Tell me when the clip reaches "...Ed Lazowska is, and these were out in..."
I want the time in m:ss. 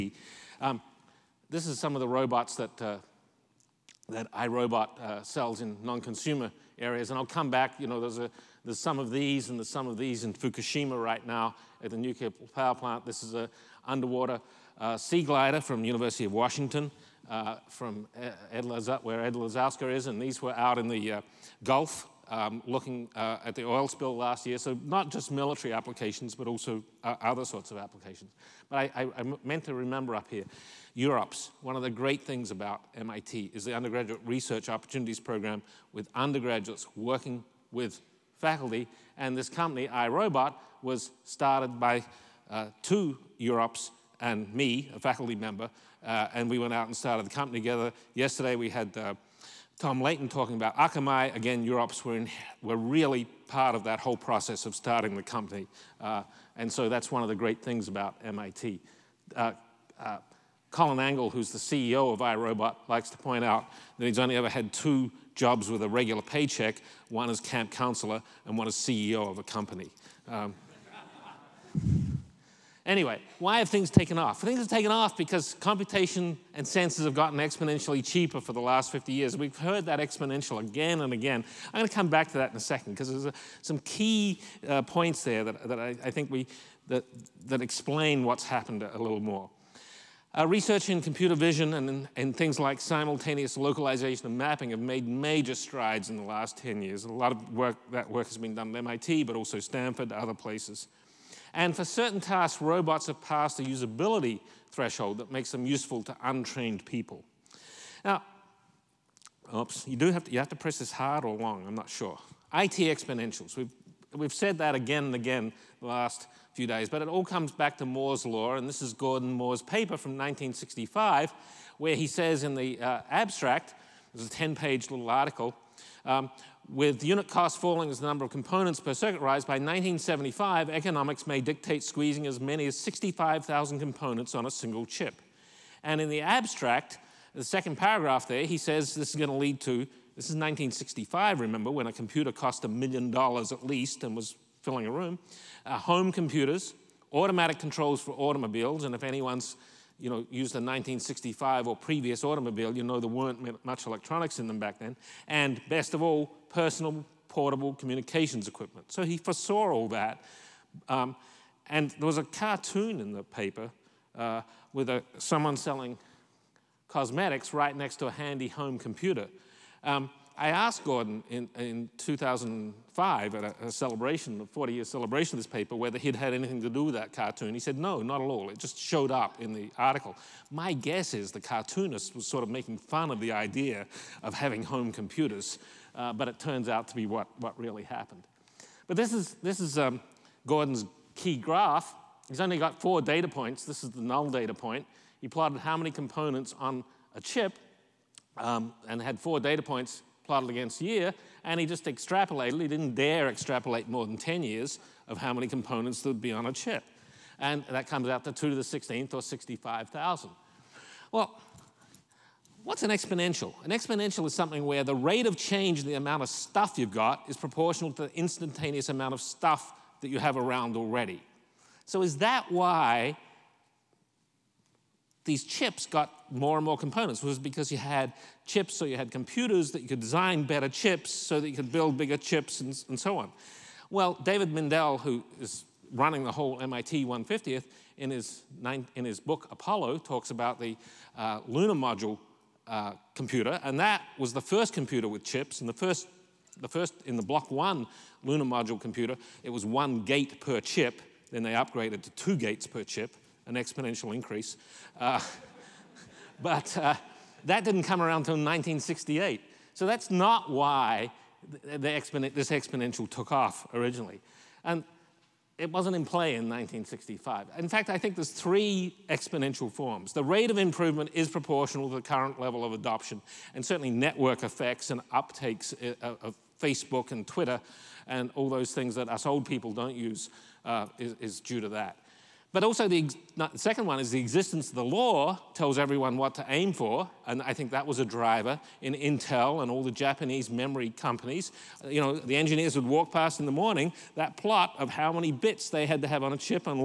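0:19.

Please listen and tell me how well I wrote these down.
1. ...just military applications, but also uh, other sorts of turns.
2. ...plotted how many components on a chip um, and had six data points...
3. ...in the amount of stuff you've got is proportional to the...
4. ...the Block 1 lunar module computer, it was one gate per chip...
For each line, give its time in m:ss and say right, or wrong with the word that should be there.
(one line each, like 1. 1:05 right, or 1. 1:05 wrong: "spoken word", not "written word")
1. 0:25 wrong: "applications", not "turns"
2. 3:15 wrong: "four", not "six"
3. 3:35 right
4. 4:07 right.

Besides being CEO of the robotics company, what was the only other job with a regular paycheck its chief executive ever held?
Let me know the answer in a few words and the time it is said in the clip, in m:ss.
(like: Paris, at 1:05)
Camp counselor, at 1:07.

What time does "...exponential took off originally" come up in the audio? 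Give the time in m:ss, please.
4:22.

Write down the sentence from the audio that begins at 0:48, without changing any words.
Yesterday we had uh, Tom Leighton talking about Akamai.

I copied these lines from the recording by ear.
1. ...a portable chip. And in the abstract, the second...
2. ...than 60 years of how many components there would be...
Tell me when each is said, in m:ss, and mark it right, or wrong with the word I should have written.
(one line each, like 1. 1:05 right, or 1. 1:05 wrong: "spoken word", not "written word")
1. 2:14 wrong: "single", not "portable"
2. 3:24 wrong: "10", not "60".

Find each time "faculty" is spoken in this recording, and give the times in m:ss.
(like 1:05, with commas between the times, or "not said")
0:38, 0:44.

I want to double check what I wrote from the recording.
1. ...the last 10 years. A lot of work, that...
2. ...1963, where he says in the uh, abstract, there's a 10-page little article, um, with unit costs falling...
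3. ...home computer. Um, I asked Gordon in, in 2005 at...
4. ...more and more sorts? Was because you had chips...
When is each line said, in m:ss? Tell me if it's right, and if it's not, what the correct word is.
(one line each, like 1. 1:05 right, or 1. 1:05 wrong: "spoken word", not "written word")
1. 1:36 right
2. 2:00 wrong: "1965", not "1963"
3. 2:48 right
4. 3:46 wrong: "components", not "sorts".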